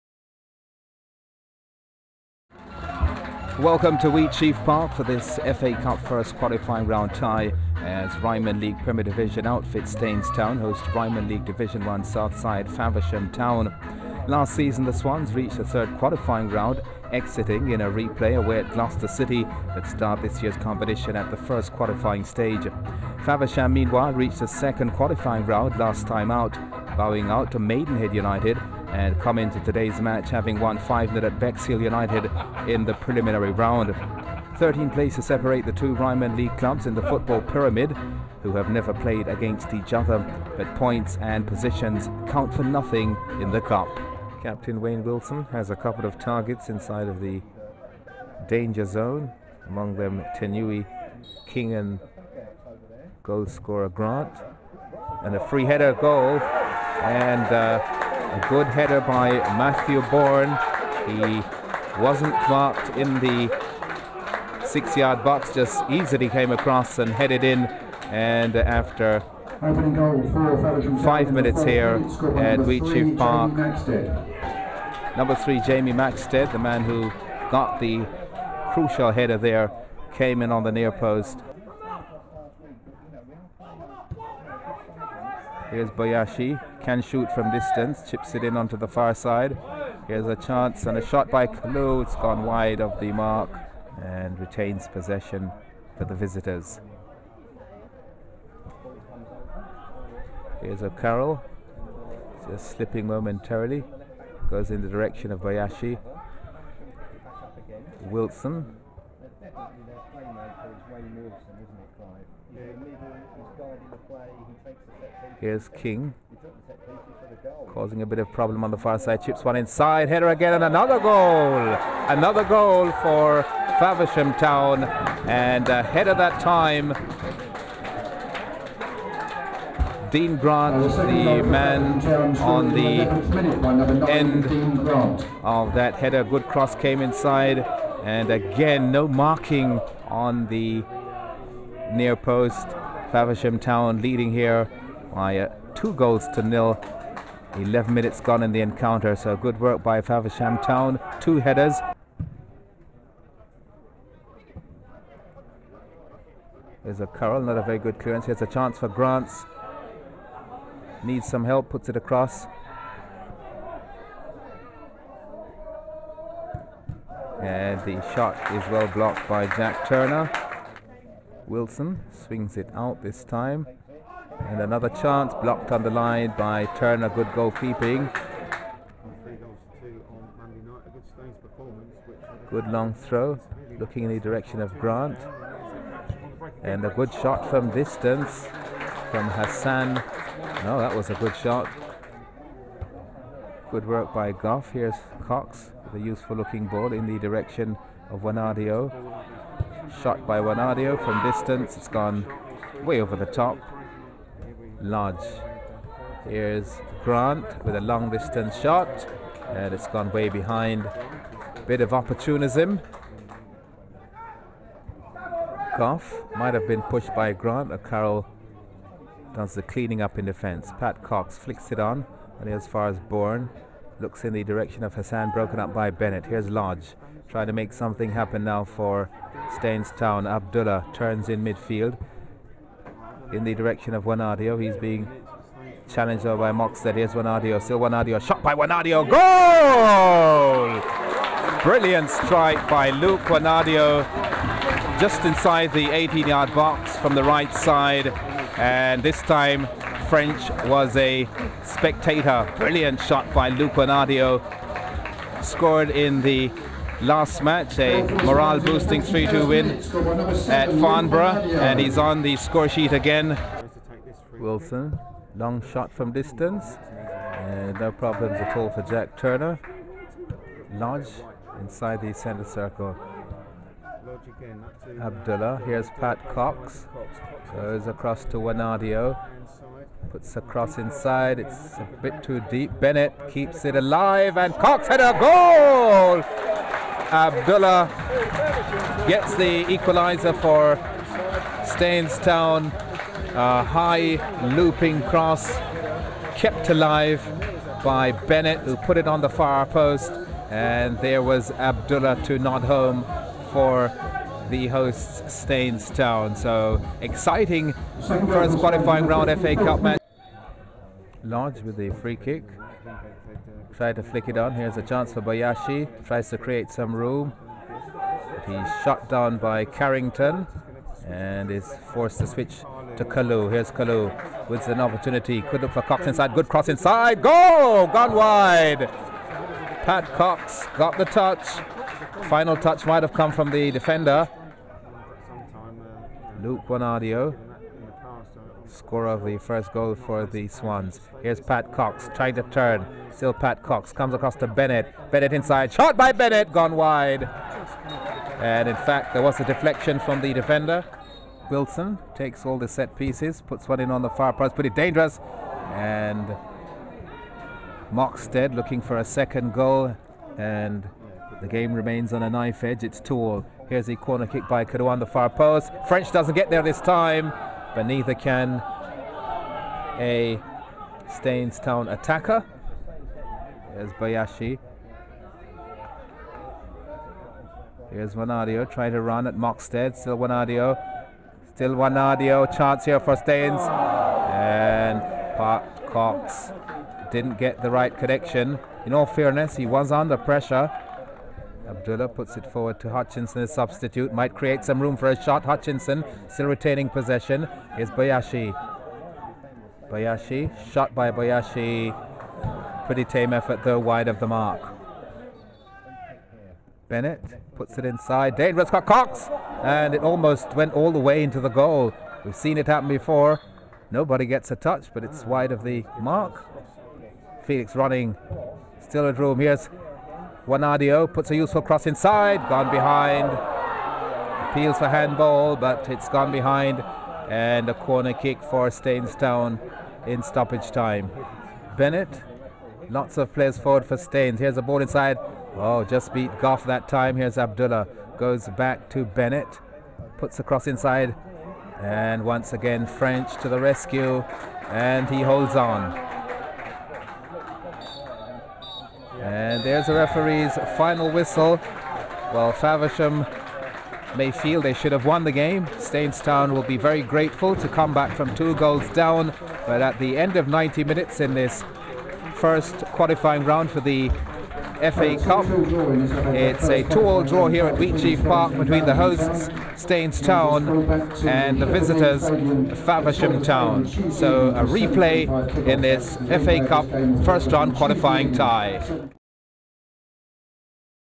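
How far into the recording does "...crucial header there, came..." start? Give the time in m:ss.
1:18.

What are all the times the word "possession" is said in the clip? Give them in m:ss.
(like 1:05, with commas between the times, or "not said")
1:34, 6:36.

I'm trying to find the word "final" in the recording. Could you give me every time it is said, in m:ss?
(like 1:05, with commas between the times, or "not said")
5:32, 7:30.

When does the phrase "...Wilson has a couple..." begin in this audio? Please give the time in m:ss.
0:45.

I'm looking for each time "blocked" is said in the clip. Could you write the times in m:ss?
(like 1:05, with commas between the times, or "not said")
2:48, 2:55.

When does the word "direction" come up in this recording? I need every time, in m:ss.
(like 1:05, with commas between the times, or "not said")
1:44, 3:04, 3:17, 3:44, 3:53.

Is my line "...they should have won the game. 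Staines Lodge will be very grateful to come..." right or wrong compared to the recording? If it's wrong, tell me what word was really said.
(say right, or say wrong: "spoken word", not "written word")
wrong: "Town", not "Lodge".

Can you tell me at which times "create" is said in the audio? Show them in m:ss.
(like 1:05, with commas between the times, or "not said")
5:16, 6:34.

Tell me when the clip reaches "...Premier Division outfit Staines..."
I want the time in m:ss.
0:08.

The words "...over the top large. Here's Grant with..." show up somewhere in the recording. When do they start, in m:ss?
3:23.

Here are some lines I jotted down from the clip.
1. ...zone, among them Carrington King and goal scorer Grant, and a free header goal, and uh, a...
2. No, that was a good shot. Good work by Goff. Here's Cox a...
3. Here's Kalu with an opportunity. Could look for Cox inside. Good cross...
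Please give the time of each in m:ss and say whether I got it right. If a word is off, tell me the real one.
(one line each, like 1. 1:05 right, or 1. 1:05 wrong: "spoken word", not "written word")
1. 0:48 wrong: "Tenui", not "Carrington"
2. 3:10 right
3. 5:23 right.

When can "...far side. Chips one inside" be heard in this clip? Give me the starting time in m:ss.
1:58.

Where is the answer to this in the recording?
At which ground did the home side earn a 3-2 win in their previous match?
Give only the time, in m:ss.
4:20.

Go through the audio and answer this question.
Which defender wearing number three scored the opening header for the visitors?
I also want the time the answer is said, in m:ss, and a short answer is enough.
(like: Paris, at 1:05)
Jamie Maxted, at 1:15.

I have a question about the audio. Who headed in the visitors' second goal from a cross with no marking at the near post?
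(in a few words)
Dean Grant.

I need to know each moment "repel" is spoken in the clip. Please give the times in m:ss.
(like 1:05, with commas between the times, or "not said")
not said.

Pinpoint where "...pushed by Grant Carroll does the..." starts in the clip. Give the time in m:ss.
3:36.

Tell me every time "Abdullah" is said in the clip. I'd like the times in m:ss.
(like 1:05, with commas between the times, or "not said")
3:50, 4:35, 4:47, 5:01, 6:31, 7:17.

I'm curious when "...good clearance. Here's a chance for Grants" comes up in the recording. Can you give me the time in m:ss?
2:37.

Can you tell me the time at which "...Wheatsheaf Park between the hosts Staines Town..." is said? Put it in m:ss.
7:47.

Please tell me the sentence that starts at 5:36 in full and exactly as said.
Luke Bonadio score of the first goal for the Swans.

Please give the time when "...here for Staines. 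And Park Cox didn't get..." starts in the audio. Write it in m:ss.
6:22.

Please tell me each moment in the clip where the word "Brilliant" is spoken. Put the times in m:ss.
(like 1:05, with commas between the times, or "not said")
4:01, 4:12.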